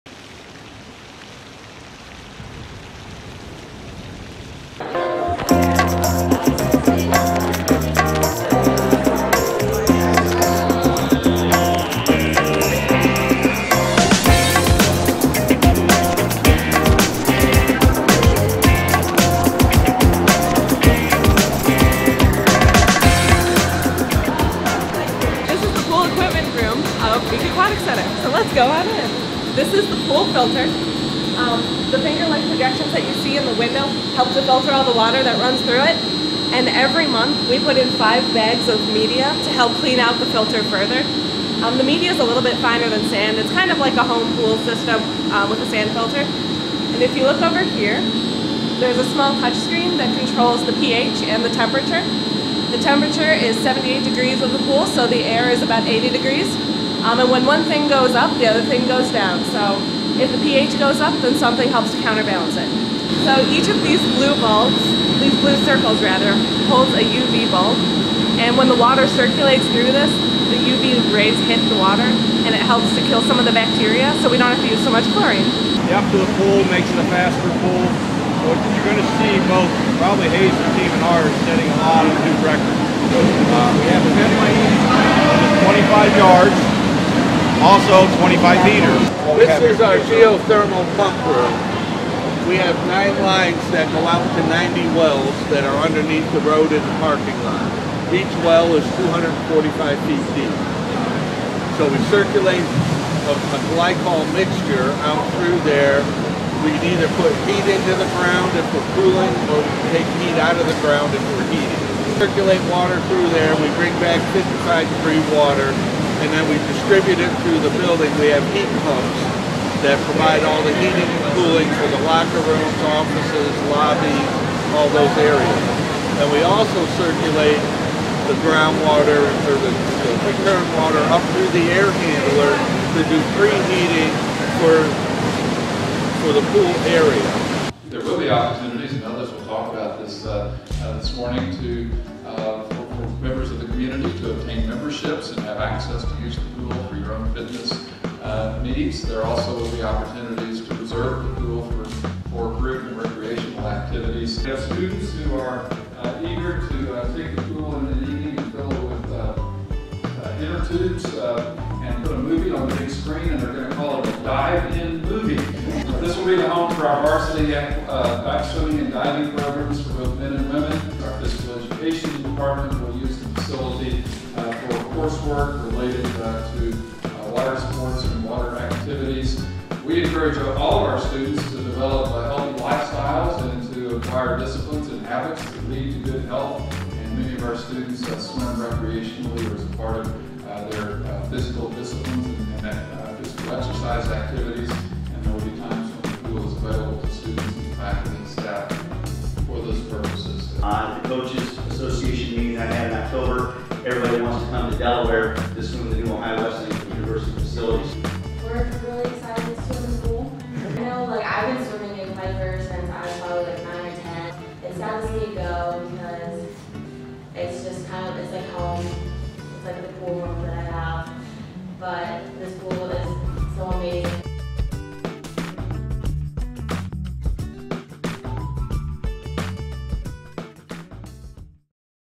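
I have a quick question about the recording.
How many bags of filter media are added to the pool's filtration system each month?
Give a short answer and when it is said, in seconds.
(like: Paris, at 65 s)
5, at 37 s.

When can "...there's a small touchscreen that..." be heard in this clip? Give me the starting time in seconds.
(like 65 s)
48 s.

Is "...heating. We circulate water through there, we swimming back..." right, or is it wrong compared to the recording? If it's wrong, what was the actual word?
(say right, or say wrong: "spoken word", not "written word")
wrong: "bring", not "swimming".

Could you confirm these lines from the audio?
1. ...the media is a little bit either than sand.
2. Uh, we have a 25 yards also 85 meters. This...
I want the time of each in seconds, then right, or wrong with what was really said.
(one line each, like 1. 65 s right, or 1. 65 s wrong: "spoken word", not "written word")
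1. 41 s wrong: "finer", not "either"
2. 83 s wrong: "25", not "85".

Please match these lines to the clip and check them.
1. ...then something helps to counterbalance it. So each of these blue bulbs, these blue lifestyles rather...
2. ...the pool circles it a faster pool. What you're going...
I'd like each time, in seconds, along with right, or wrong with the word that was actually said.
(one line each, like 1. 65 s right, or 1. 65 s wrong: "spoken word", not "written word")
1. 61 s wrong: "circles", not "lifestyles"
2. 76 s wrong: "makes", not "circles".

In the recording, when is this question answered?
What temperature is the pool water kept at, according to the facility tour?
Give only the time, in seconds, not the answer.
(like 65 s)
53 s.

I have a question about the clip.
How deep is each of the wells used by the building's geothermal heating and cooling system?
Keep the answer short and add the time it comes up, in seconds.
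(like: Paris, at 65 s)
245 feet, at 98 s.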